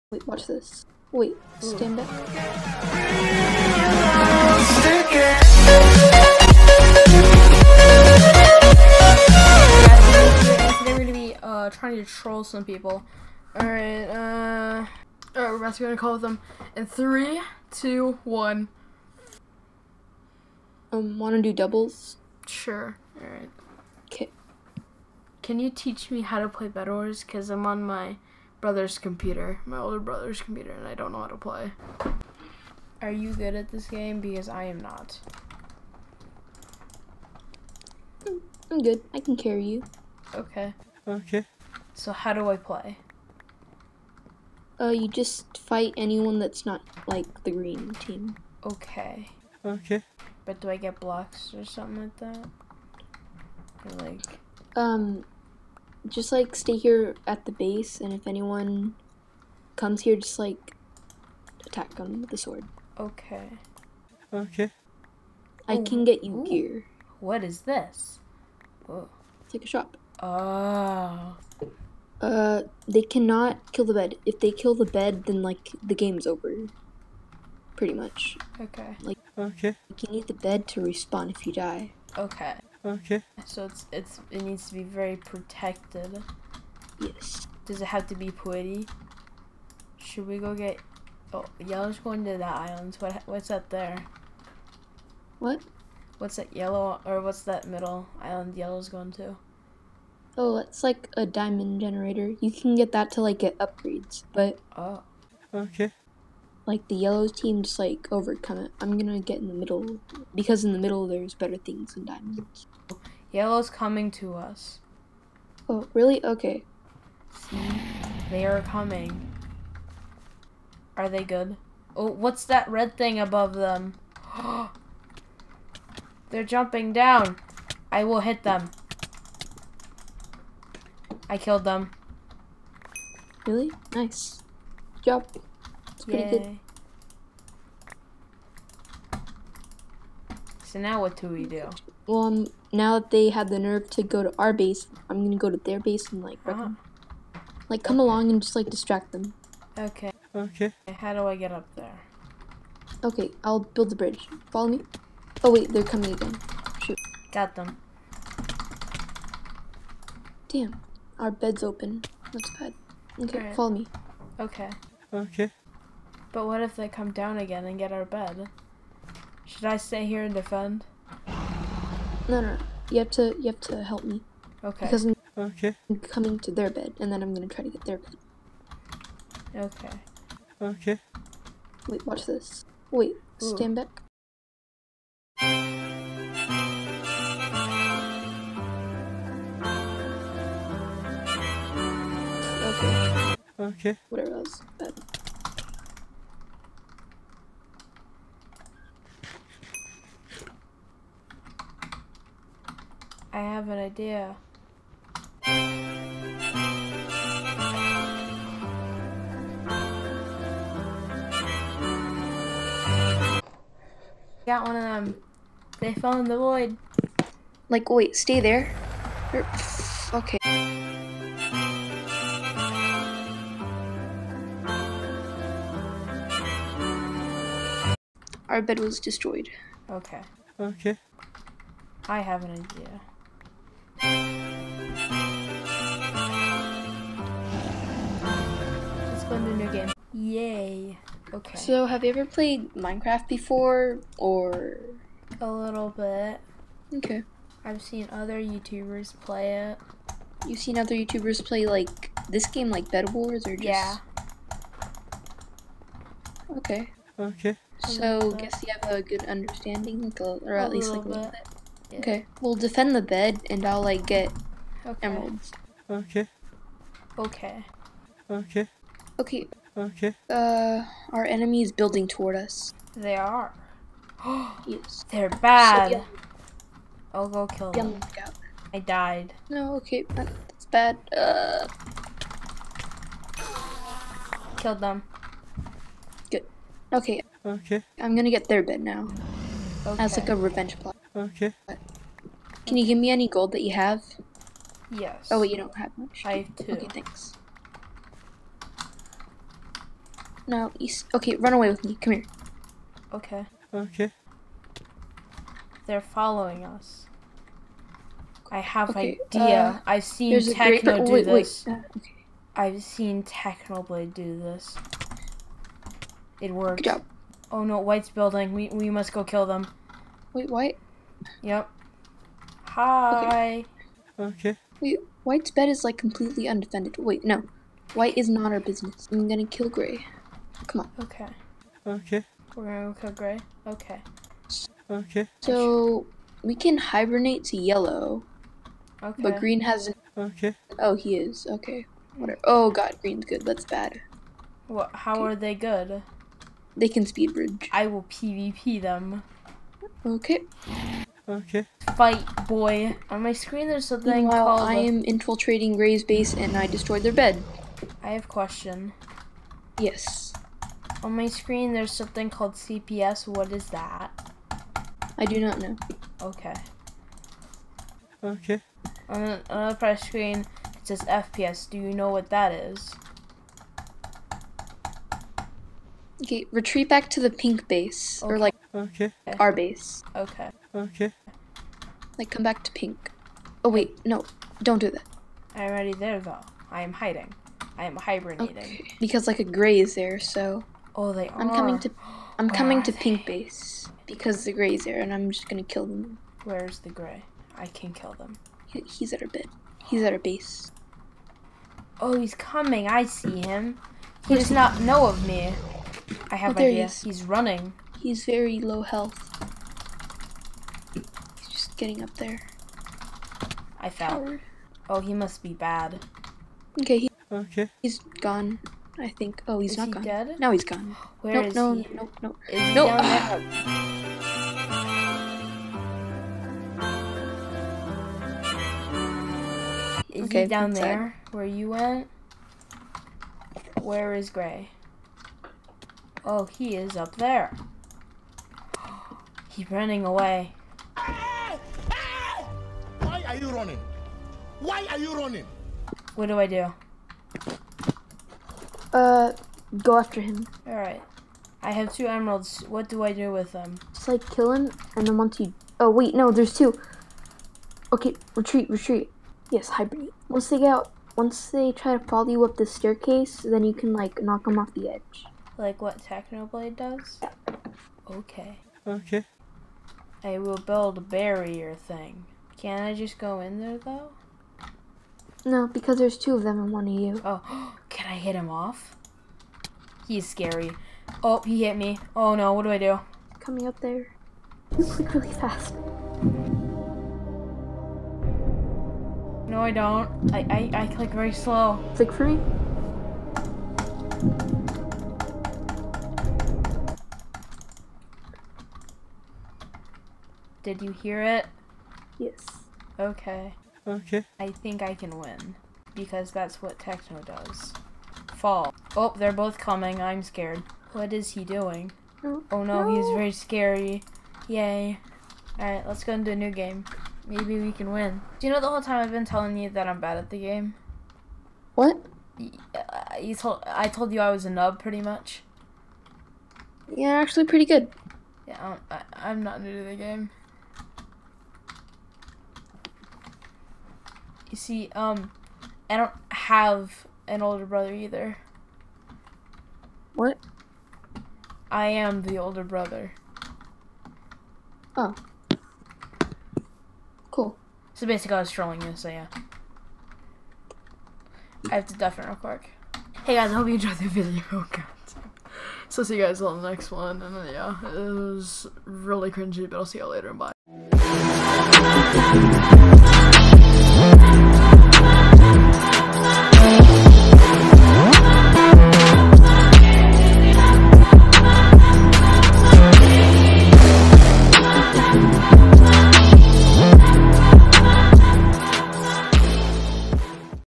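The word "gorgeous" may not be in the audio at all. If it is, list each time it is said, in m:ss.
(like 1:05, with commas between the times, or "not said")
not said.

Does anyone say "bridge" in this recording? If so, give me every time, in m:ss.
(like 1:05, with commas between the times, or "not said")
2:33, 5:47.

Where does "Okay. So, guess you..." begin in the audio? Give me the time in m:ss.
4:17.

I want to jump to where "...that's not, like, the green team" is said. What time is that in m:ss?
0:46.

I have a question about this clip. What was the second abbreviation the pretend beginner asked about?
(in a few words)
FPS.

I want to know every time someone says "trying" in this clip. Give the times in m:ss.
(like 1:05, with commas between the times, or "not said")
0:11.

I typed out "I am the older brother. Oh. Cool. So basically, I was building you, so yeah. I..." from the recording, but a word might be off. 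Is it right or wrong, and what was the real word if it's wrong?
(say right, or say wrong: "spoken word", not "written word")
wrong: "trolling", not "building".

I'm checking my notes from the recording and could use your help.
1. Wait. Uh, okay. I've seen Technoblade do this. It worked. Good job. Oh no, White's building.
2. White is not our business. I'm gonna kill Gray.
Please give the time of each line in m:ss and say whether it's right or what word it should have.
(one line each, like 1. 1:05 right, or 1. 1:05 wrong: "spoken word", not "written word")
1. 5:11 right
2. 5:27 right.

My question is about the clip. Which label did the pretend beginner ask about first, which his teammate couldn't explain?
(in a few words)
CPS.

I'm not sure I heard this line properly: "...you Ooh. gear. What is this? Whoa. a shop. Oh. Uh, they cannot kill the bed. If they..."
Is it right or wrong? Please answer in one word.
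right.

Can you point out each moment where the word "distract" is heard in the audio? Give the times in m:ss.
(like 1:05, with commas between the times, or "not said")
2:28.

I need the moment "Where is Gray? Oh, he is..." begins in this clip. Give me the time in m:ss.
7:13.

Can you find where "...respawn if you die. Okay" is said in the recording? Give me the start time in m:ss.
1:20.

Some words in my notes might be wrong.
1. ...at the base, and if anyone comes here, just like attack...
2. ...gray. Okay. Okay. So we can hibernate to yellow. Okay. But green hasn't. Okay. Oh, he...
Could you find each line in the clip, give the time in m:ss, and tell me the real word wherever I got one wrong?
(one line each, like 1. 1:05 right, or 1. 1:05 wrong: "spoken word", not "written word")
1. 0:57 right
2. 5:33 right.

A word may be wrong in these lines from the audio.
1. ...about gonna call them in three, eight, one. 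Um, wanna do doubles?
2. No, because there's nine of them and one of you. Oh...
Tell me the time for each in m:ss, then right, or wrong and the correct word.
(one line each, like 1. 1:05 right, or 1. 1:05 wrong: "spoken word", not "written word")
1. 0:15 wrong: "two", not "eight"
2. 7:55 wrong: "two", not "nine".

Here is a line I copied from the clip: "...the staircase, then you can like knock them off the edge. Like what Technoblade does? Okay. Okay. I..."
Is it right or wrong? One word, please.
right.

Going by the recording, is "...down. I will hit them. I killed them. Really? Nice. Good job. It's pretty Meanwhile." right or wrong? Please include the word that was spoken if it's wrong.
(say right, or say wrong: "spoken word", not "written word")
wrong: "Yay", not "Meanwhile".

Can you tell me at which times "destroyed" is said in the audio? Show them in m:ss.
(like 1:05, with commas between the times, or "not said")
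3:48, 5:56.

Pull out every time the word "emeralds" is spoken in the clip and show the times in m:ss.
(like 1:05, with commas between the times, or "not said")
4:25, 7:32.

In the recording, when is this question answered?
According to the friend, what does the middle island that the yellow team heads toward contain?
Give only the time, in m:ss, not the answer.
1:41.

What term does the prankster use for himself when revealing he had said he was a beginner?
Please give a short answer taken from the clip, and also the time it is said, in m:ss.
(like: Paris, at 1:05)
Nub, at 8:44.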